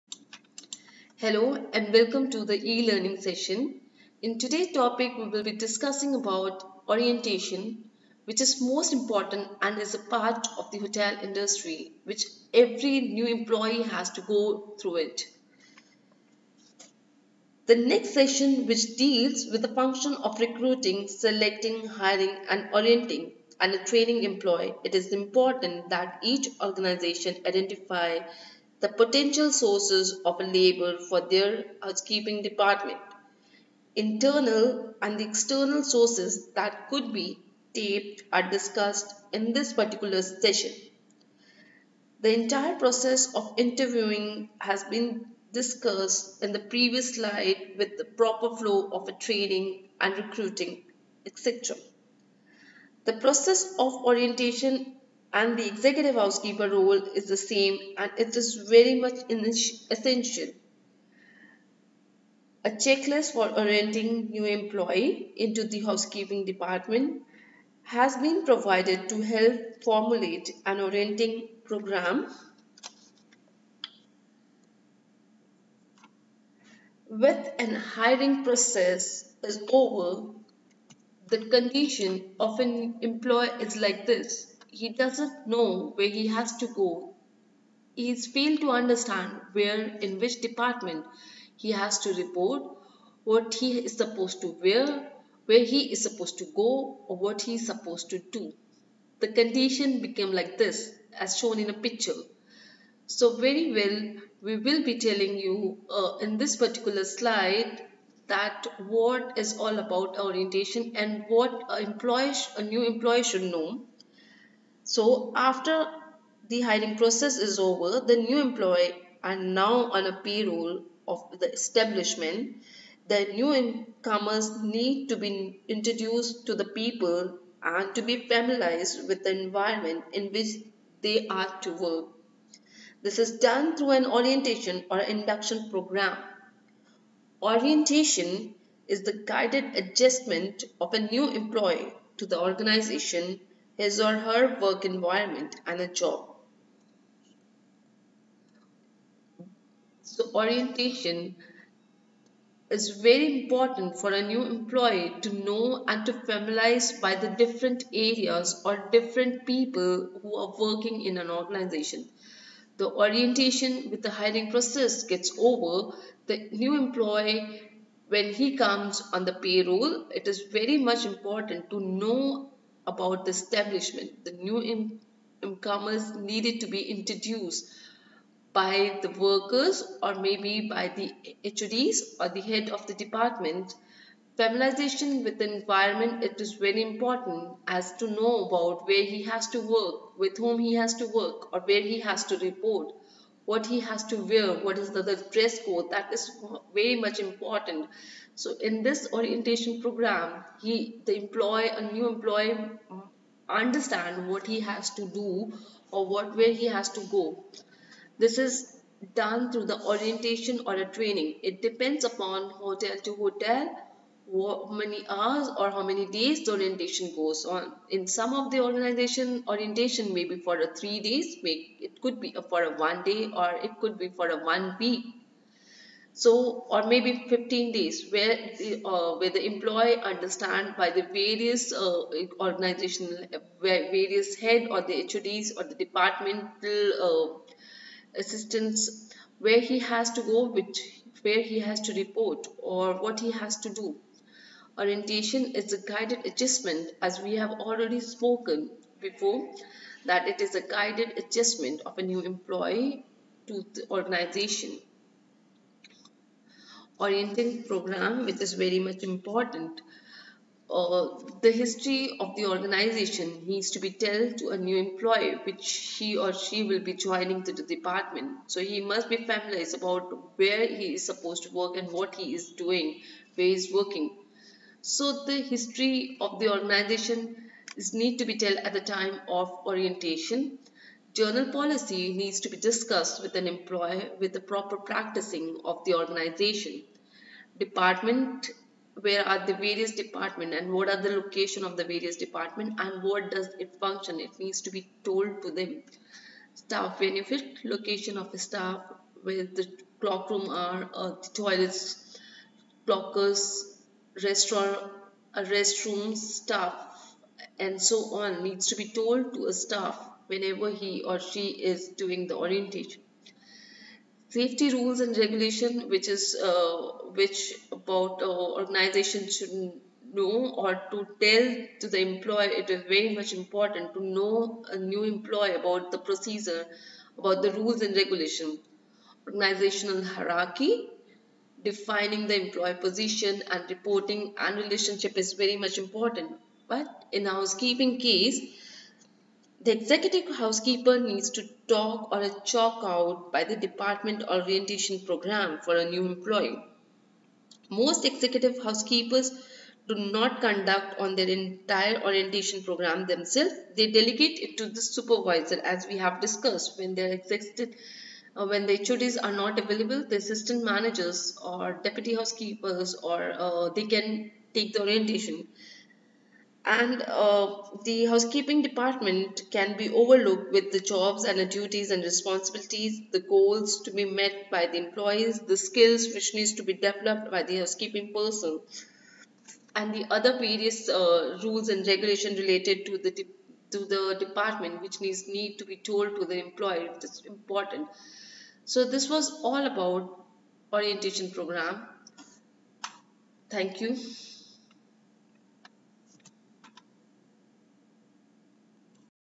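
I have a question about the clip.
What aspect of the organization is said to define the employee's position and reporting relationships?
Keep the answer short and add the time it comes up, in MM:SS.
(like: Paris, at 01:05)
Organizational hierarchy, at 05:29.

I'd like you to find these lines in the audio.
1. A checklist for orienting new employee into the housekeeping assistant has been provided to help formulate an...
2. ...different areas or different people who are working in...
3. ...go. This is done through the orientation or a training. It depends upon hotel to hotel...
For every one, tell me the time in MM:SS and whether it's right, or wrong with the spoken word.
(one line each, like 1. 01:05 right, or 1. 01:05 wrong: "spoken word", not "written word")
1. 01:02 wrong: "department", not "assistant"
2. 02:37 right
3. 03:27 right.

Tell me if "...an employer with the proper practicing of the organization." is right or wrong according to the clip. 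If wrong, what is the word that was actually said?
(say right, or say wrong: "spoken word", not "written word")
right.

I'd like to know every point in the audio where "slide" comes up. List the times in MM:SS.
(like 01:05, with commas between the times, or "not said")
00:47, 01:47.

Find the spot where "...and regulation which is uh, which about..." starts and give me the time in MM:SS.
05:14.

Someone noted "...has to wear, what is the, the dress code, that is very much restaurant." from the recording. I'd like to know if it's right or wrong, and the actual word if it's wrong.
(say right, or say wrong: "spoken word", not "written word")
wrong: "important", not "restaurant".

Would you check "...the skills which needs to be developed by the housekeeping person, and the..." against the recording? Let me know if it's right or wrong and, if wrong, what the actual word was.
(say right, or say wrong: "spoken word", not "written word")
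right.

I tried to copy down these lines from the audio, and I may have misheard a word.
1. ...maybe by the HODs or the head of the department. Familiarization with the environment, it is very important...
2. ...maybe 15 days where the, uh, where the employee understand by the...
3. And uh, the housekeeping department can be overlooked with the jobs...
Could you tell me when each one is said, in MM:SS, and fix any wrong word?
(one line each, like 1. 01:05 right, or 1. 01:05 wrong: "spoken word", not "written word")
1. 03:00 right
2. 03:46 right
3. 06:06 right.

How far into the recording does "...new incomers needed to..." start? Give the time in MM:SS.
02:54.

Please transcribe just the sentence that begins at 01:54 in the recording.
So after the hiring process is over, the new employee are now on a payroll of the establishment.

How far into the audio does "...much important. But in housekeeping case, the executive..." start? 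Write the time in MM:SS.
05:35.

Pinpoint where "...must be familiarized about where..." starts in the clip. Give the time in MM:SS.
04:28.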